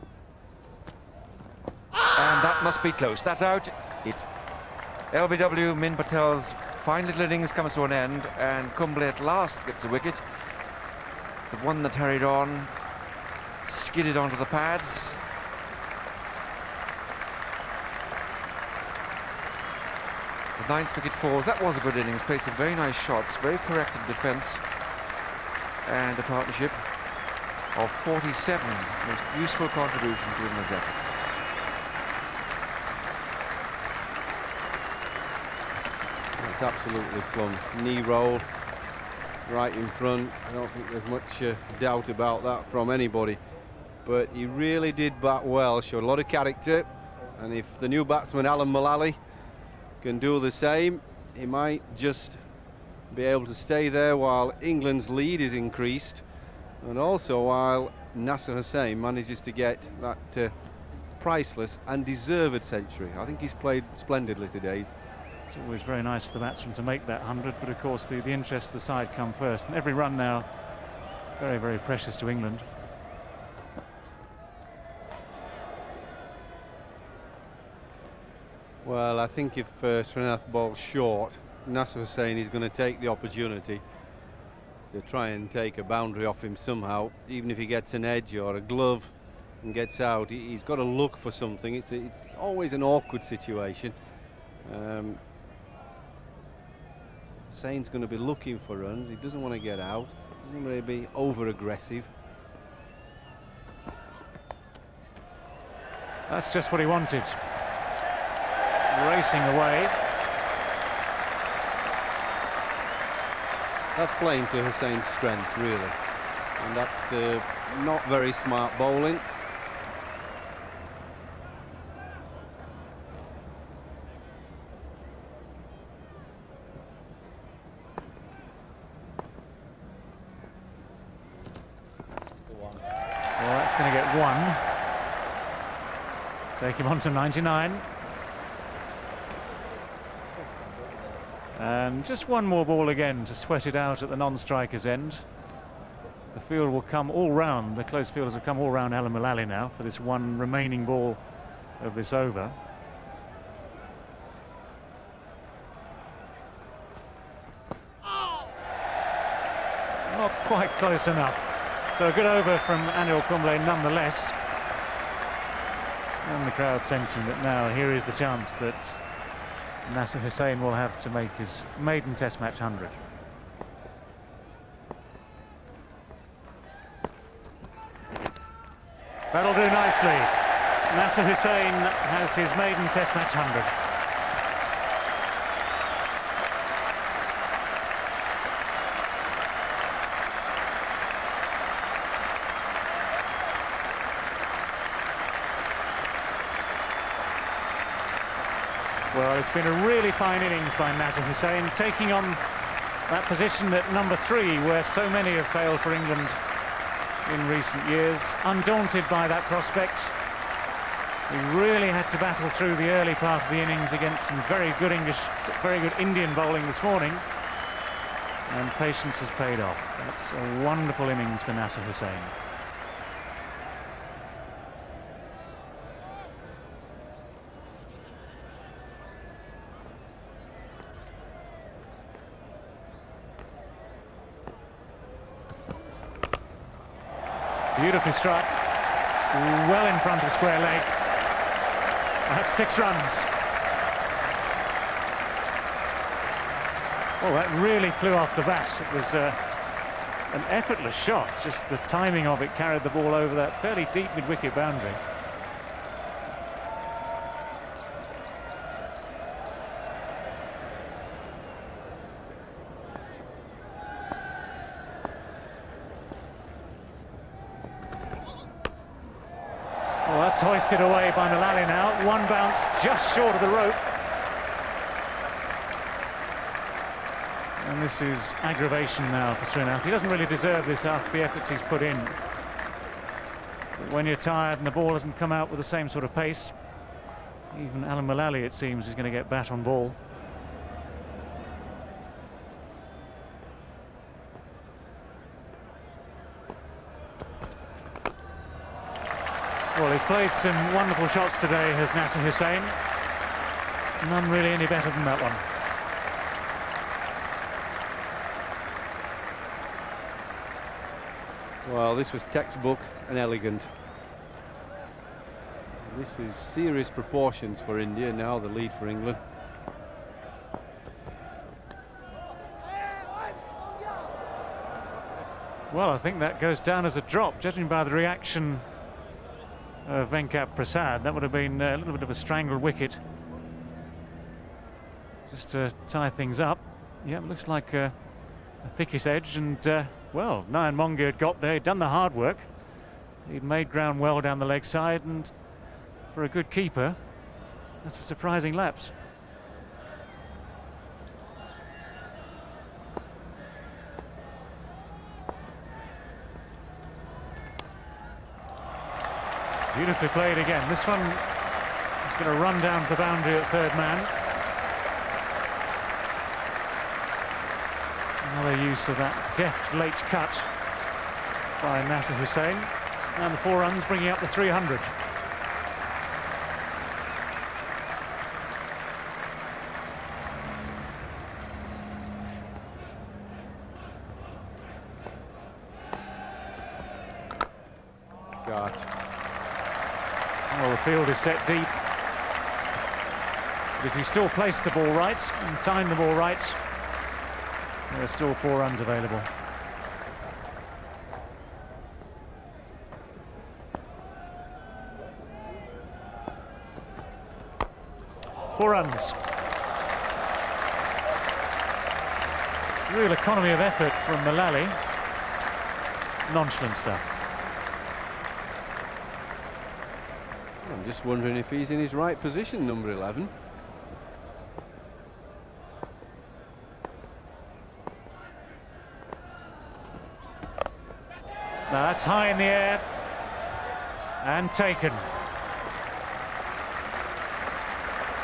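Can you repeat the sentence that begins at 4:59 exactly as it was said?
Well, he's played some wonderful shots today, has Nasser Hussain.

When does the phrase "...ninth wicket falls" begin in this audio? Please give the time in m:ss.
0:20.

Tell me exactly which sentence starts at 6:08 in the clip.
Another use of that deft late cut by Nasser Hussain.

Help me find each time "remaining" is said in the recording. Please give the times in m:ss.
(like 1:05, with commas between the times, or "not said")
2:30.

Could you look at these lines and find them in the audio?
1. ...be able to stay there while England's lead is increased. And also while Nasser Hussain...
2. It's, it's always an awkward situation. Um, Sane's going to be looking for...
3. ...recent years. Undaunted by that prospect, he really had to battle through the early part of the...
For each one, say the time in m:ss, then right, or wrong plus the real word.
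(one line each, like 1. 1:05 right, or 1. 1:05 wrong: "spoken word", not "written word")
1. 0:53 right
2. 1:31 right
3. 3:27 right.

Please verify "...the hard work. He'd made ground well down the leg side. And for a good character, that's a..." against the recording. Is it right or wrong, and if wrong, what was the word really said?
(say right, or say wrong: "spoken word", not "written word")
wrong: "keeper", not "character".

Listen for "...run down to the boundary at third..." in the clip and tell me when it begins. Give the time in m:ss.
6:02.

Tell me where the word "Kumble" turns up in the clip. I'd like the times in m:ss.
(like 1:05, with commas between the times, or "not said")
0:08, 2:43.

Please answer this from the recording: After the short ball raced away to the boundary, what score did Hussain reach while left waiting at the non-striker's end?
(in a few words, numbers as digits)
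99.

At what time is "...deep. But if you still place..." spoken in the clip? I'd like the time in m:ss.
6:31.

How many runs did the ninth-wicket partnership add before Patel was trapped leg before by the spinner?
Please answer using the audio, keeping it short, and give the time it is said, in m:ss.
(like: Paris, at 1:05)
47, at 0:28.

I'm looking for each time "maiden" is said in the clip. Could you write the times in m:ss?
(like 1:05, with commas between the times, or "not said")
2:51, 3:02.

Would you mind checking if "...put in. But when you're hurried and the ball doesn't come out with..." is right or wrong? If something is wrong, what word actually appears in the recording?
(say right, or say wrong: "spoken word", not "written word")
wrong: "tired", not "hurried".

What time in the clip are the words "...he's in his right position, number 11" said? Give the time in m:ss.
7:01.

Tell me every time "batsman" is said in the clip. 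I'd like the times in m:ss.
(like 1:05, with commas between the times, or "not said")
0:48, 1:06.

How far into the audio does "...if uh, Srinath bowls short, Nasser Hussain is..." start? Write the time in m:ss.
1:19.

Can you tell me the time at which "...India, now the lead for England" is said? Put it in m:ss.
5:17.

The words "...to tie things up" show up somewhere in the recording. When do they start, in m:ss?
5:35.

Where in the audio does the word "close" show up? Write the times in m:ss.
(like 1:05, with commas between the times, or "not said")
0:02, 2:27, 2:40.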